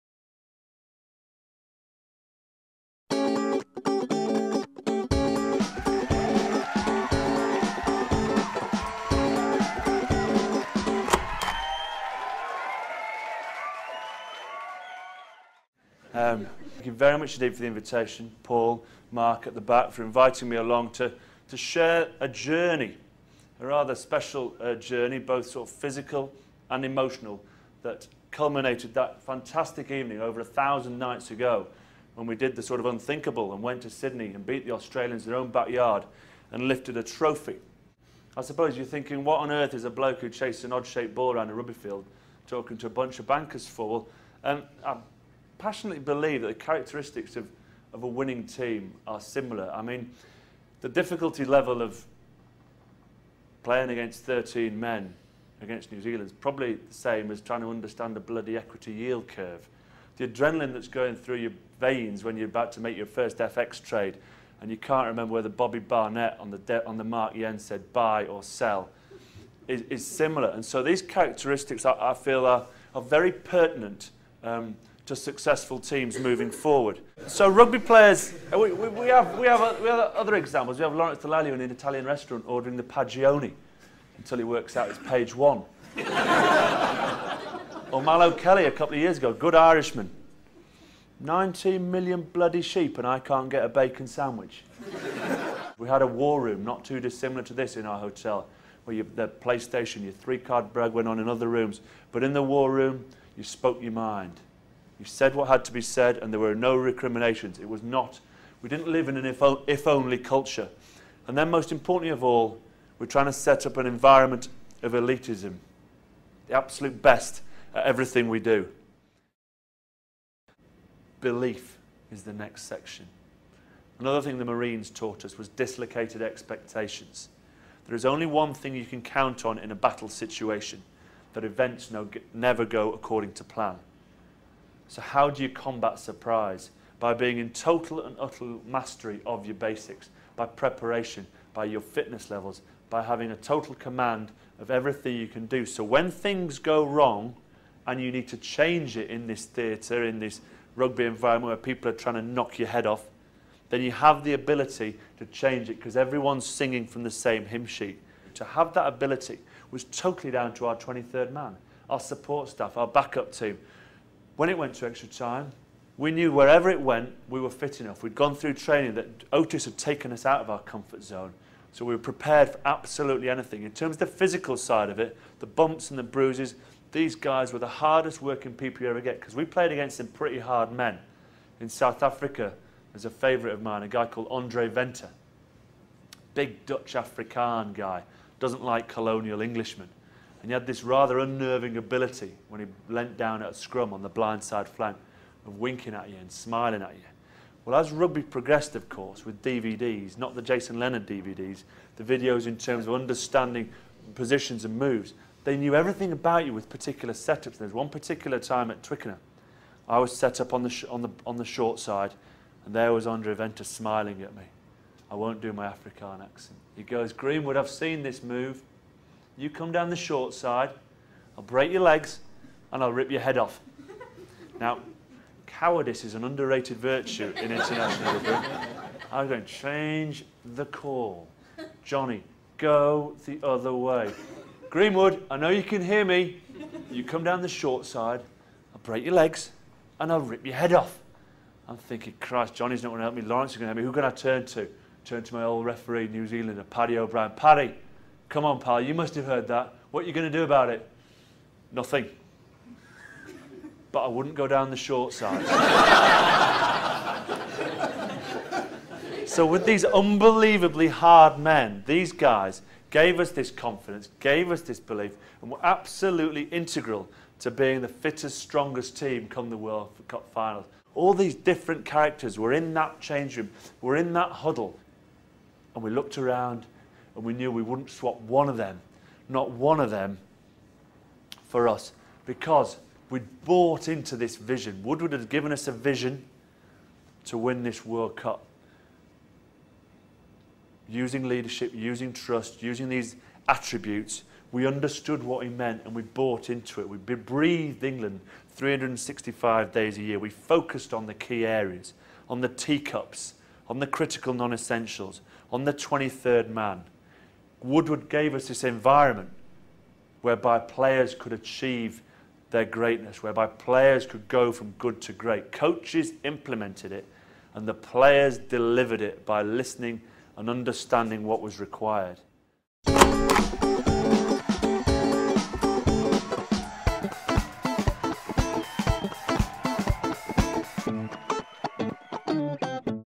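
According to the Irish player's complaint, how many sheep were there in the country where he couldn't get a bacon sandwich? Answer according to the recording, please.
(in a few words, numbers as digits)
19 million.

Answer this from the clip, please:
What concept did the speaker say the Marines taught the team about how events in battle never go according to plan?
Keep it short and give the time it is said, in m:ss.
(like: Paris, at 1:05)
dislocated expectations, at 2:05.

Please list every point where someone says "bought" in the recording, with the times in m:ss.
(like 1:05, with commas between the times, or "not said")
4:43, 4:56.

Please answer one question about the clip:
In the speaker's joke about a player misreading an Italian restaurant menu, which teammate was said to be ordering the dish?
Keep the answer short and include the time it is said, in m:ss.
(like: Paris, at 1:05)
Lawrence Dallaglio, at 1:20.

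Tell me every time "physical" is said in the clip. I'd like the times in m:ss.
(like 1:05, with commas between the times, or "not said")
0:25, 2:54.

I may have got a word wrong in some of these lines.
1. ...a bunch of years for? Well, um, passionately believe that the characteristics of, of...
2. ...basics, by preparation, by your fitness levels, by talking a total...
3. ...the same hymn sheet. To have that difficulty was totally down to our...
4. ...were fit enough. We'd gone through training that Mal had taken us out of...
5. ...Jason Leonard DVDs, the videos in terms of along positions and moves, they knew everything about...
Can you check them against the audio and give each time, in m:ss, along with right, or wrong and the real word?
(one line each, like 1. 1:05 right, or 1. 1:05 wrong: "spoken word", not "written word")
1. 0:42 wrong: "bankers", not "years"
2. 2:19 wrong: "having", not "talking"
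3. 2:37 wrong: "ability", not "difficulty"
4. 2:47 wrong: "Otis", not "Mal"
5. 3:20 wrong: "understanding", not "along".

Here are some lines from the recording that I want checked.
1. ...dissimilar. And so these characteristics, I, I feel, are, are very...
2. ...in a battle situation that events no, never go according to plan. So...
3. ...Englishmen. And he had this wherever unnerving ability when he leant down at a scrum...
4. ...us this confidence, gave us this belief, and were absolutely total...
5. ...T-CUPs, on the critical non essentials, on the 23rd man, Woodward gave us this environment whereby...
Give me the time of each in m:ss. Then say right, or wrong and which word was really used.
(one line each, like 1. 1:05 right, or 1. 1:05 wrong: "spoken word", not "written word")
1. 1:10 wrong: "similar", not "dissimilar"
2. 2:09 right
3. 3:09 wrong: "rather", not "wherever"
4. 4:23 wrong: "integral", not "total"
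5. 5:02 right.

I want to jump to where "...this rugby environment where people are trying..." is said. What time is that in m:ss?
2:30.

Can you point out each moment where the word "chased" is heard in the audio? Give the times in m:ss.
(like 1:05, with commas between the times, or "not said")
0:40.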